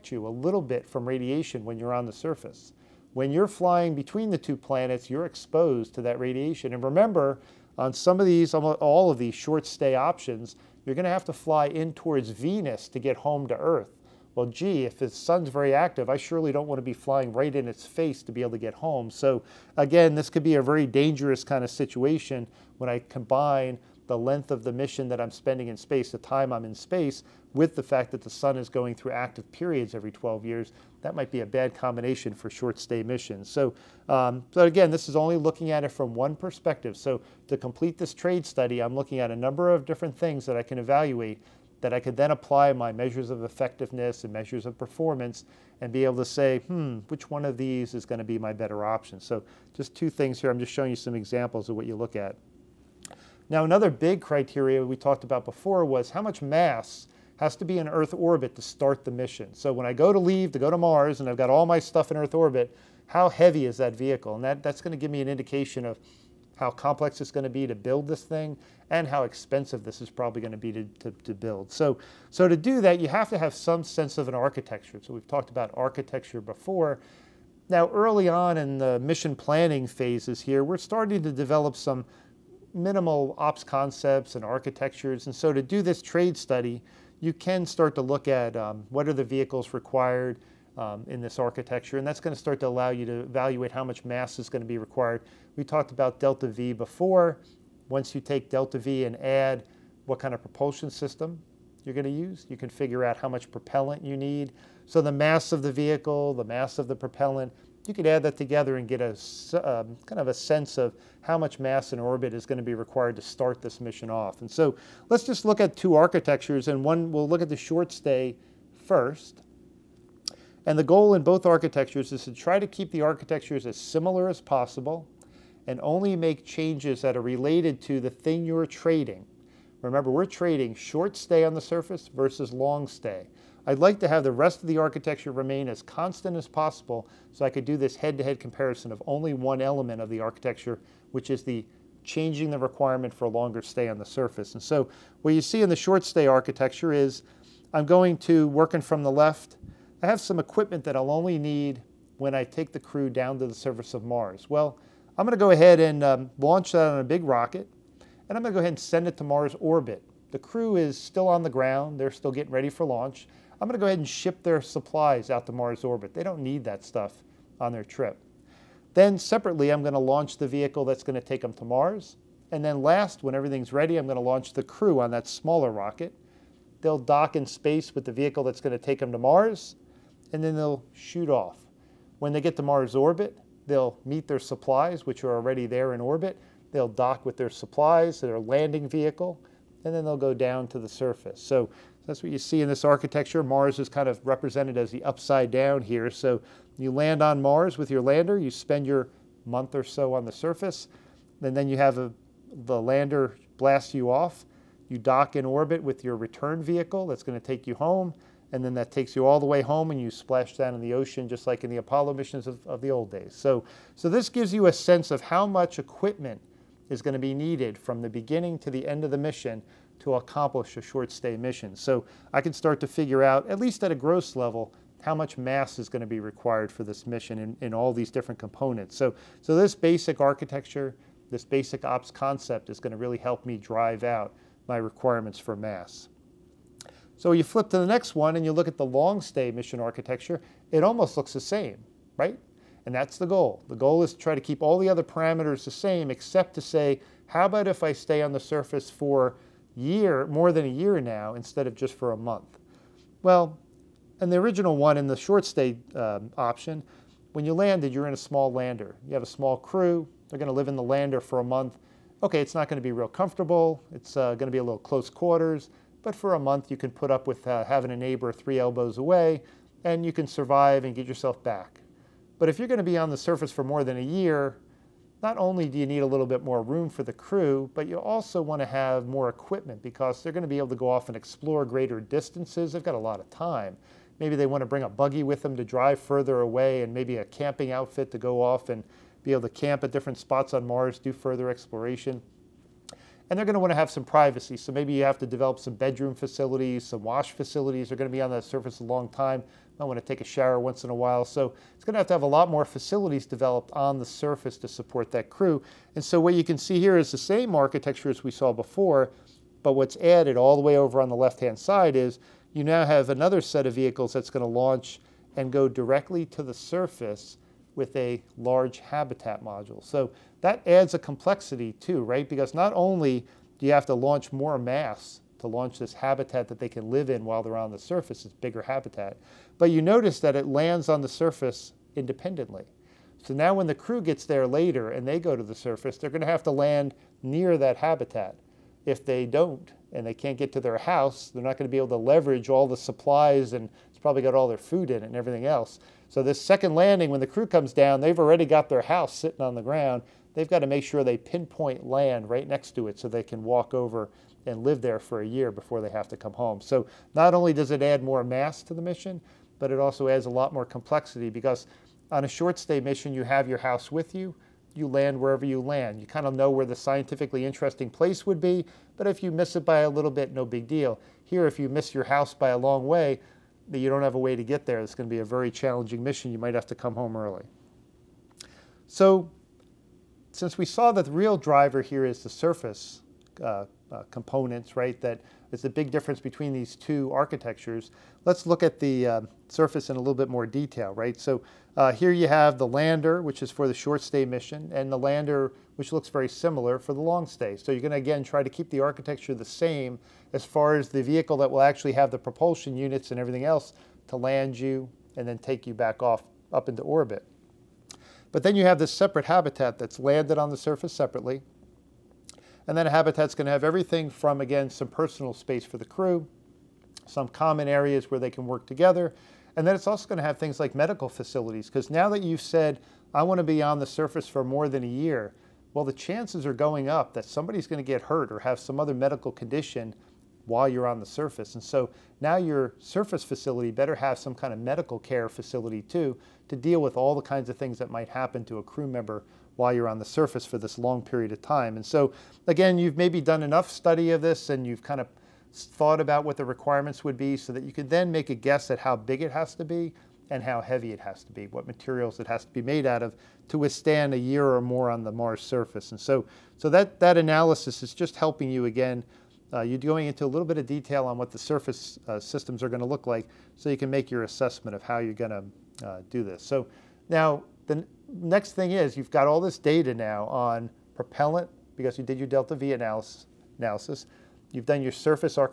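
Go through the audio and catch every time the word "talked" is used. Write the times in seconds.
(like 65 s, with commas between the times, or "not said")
54 s, 75 s, 95 s.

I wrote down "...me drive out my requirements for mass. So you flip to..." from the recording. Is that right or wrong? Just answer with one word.
right.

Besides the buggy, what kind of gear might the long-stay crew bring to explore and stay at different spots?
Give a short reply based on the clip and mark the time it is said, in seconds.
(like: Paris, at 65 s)
a camping outfit, at 287 s.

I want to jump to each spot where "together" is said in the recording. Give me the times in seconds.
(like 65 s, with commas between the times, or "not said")
108 s, 418 s.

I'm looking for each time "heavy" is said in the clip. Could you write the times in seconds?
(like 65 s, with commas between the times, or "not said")
63 s, 450 s.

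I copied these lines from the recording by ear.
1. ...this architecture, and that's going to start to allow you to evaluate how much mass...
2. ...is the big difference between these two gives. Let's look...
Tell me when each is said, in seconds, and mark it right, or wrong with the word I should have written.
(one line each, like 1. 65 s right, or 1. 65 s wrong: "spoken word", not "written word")
1. 91 s right
2. 385 s wrong: "architectures", not "gives".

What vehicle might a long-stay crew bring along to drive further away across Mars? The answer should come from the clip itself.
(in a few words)
a buggy.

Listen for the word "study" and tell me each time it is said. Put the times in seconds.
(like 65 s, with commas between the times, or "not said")
38 s, 86 s, 443 s.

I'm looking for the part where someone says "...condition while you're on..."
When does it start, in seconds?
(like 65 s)
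429 s.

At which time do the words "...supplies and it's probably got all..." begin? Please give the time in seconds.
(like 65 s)
342 s.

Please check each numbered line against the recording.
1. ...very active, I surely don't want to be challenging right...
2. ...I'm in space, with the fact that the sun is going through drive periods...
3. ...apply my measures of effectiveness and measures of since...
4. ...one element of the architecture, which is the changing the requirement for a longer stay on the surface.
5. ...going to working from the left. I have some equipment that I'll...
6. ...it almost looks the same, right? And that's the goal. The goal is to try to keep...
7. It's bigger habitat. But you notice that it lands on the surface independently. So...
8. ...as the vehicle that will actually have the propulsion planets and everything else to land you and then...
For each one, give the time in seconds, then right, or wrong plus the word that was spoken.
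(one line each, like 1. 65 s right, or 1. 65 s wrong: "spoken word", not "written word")
1. 15 s wrong: "flying", not "challenging"
2. 26 s wrong: "active", not "drive"
3. 42 s wrong: "performance", not "since"
4. 139 s right
5. 147 s right
6. 240 s right
7. 328 s right
8. 400 s wrong: "units", not "planets".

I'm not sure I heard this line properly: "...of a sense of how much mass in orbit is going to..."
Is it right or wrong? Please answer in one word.
right.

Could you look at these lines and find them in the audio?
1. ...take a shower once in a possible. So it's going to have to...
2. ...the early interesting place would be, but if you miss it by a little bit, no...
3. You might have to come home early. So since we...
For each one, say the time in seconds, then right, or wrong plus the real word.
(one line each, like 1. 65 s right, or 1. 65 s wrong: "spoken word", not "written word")
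1. 300 s wrong: "while", not "possible"
2. 366 s wrong: "scientifically", not "early"
3. 376 s right.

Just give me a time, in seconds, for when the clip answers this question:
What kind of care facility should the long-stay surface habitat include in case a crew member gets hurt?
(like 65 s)
434 s.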